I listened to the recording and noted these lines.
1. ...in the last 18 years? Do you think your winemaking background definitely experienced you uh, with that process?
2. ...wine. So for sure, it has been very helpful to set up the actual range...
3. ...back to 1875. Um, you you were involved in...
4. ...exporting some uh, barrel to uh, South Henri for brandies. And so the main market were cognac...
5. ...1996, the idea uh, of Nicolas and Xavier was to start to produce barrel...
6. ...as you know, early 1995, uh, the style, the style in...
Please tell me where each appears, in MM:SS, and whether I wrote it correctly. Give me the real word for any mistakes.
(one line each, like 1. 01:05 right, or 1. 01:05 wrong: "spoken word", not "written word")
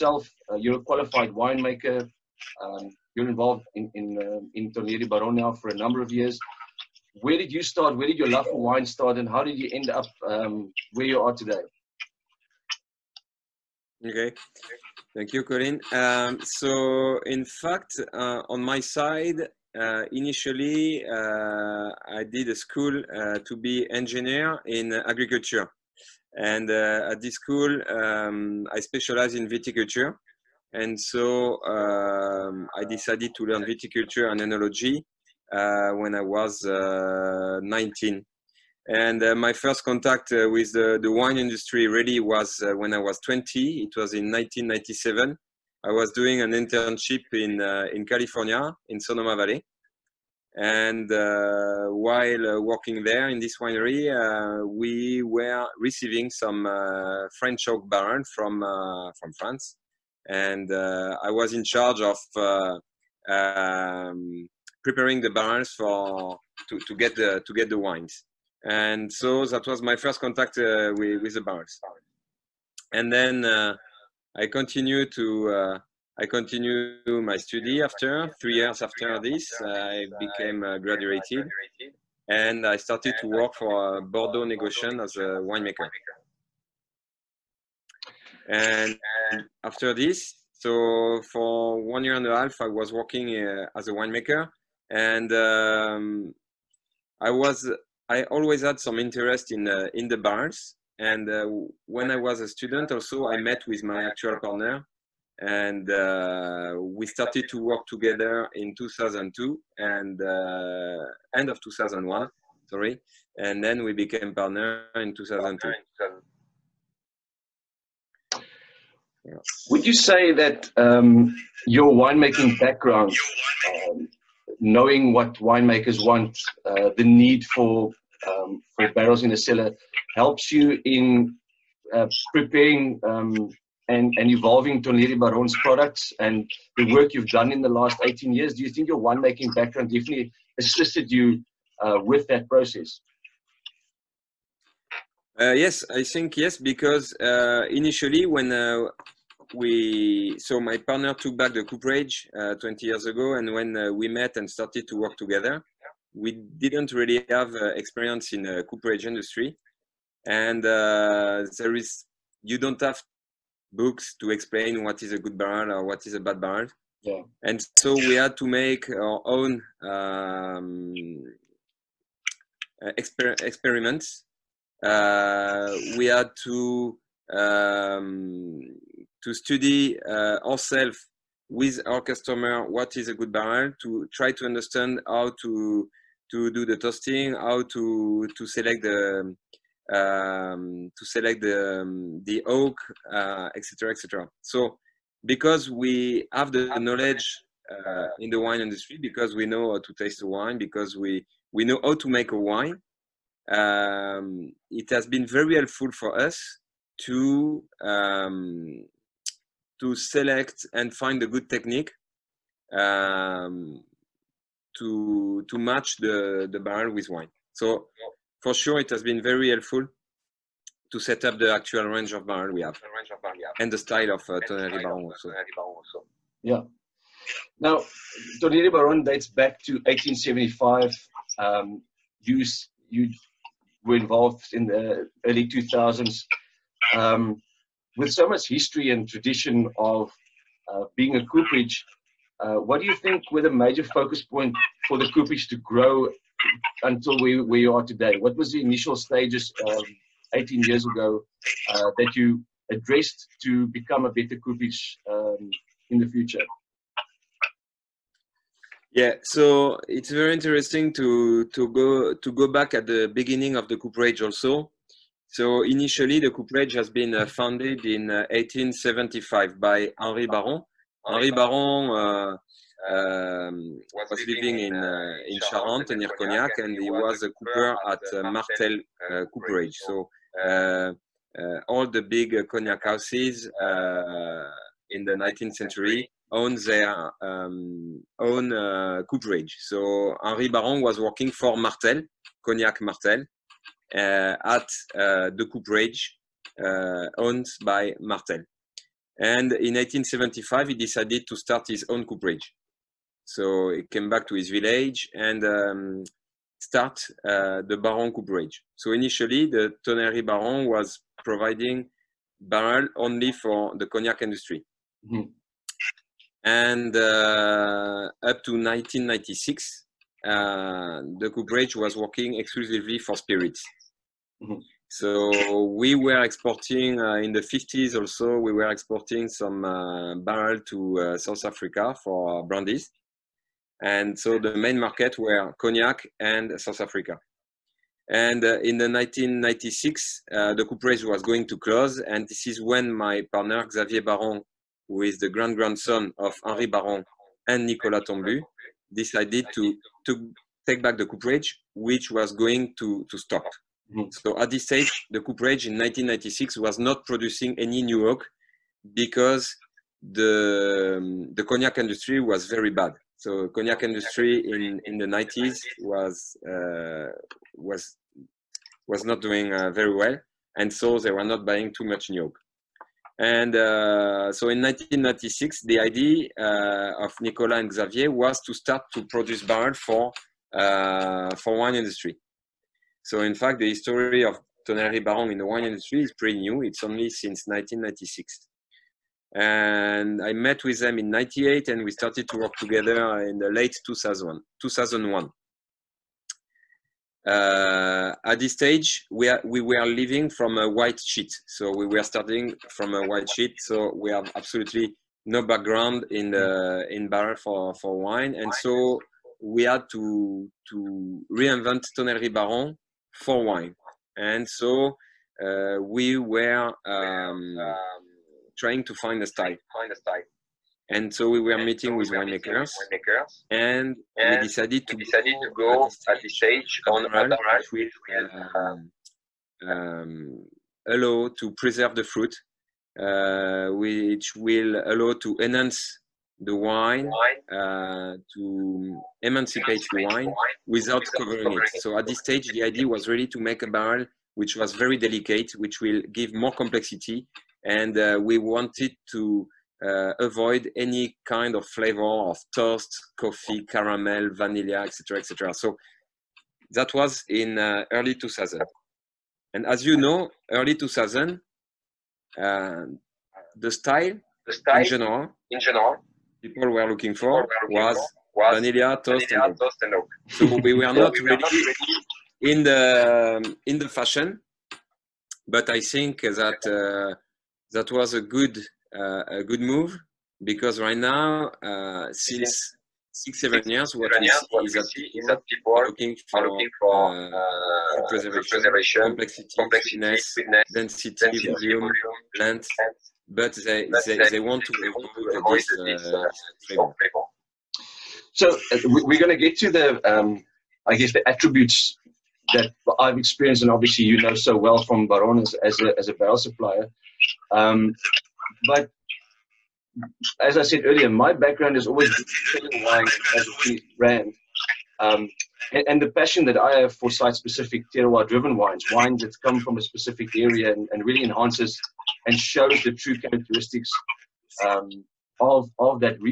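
1. 02:17 wrong: "assisted", not "experienced"
2. 03:37 right
3. 03:49 right
4. 05:28 wrong: "Africa", not "Henri"
5. 06:14 right
6. 07:39 wrong: "2000", not "1995".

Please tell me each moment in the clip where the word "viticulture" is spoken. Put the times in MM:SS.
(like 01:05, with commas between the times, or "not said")
00:29, 00:33.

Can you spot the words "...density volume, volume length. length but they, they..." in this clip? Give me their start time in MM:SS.
08:11.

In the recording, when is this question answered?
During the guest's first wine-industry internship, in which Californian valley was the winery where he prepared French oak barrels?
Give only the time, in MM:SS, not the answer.
00:48.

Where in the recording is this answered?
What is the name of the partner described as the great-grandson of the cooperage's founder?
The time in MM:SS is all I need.
05:43.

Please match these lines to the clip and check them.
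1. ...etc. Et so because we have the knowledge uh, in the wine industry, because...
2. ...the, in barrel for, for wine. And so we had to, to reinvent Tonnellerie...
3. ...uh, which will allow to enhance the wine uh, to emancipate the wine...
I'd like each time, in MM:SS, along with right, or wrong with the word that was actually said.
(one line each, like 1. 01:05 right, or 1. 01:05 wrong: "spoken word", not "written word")
1. 03:13 right
2. 06:46 right
3. 07:12 right.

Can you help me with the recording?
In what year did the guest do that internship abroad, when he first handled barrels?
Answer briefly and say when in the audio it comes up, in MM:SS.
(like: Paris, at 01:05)
1997, at 00:44.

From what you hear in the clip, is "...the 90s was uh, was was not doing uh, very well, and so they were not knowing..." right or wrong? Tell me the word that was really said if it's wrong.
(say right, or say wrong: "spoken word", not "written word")
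wrong: "buying", not "knowing".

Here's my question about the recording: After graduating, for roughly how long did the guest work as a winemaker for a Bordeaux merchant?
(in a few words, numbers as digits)
one year and a half.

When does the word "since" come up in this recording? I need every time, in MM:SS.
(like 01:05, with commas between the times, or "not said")
06:27, 08:02.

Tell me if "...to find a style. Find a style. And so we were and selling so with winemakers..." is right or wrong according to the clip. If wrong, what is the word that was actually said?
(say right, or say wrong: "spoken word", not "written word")
wrong: "meeting", not "selling".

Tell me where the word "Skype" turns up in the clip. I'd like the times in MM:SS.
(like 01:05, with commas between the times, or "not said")
not said.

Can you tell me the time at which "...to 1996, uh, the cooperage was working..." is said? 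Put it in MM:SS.
05:18.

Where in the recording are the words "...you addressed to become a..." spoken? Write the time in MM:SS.
04:12.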